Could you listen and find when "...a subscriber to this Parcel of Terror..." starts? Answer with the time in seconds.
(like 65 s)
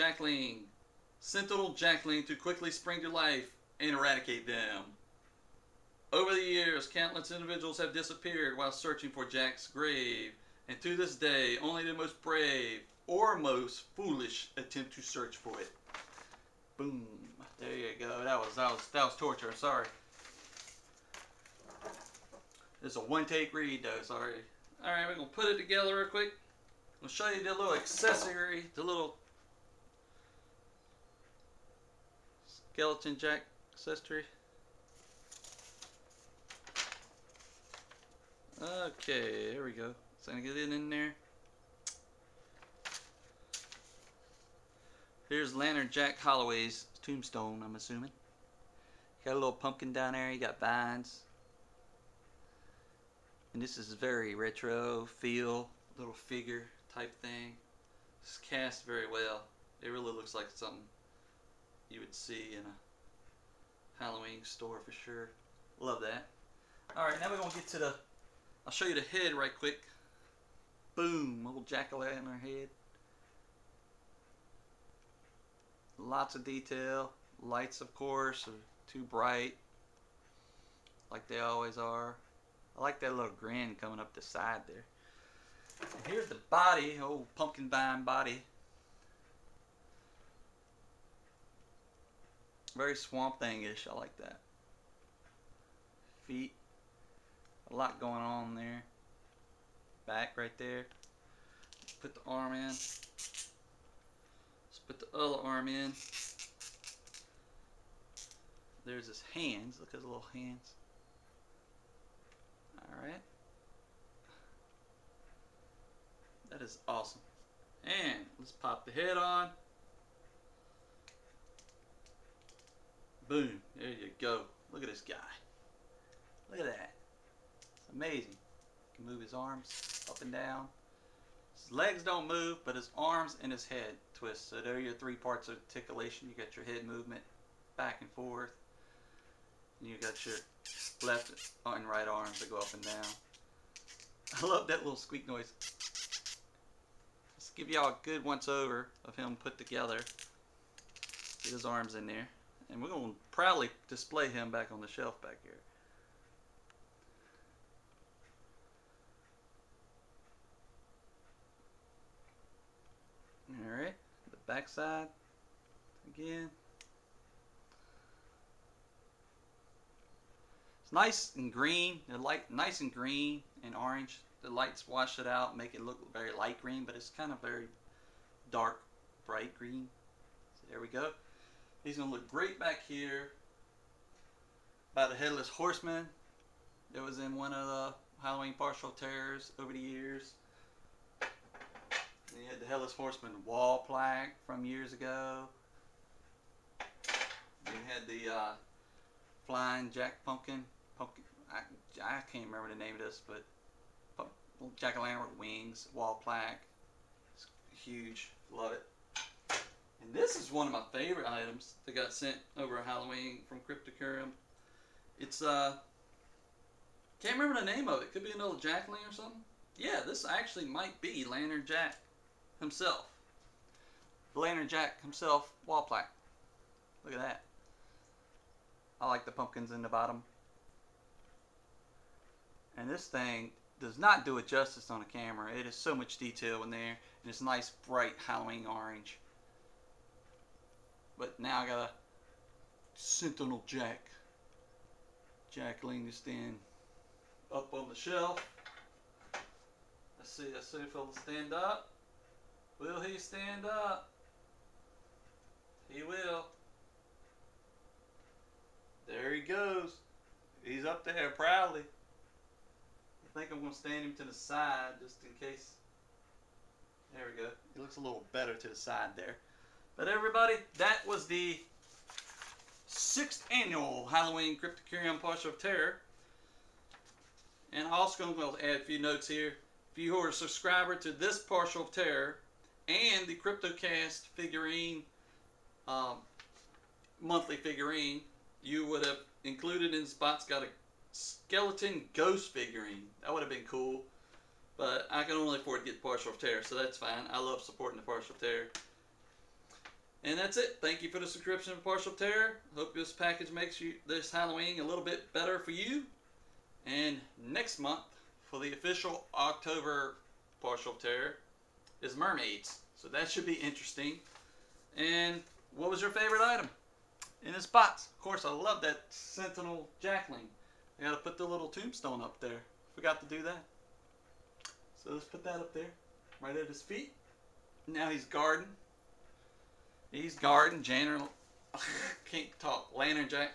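280 s.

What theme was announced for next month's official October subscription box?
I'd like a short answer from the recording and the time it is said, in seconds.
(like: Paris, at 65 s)
Mermaids, at 312 s.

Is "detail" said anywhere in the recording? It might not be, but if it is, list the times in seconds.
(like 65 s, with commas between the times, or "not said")
76 s, 236 s.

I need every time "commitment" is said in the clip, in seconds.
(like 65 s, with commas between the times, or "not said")
not said.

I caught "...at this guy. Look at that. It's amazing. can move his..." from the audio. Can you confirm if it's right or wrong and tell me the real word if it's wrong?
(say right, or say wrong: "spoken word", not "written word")
right.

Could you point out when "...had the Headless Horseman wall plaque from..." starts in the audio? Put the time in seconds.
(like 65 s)
192 s.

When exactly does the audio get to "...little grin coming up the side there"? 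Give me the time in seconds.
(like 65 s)
83 s.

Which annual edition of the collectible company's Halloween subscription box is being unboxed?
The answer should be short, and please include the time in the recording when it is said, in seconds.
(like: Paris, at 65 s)
sixth, at 272 s.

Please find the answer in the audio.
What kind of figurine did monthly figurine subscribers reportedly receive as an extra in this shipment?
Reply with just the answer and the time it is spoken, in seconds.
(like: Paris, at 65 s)
skeleton ghost figurine, at 291 s.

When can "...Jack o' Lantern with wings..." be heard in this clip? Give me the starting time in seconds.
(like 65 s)
204 s.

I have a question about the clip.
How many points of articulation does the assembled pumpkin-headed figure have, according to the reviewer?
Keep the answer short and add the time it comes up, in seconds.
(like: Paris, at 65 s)
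3, at 134 s.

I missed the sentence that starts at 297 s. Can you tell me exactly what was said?
I love supporting the Parcel of Terror.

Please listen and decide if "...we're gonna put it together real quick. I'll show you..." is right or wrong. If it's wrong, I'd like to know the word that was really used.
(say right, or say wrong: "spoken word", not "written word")
right.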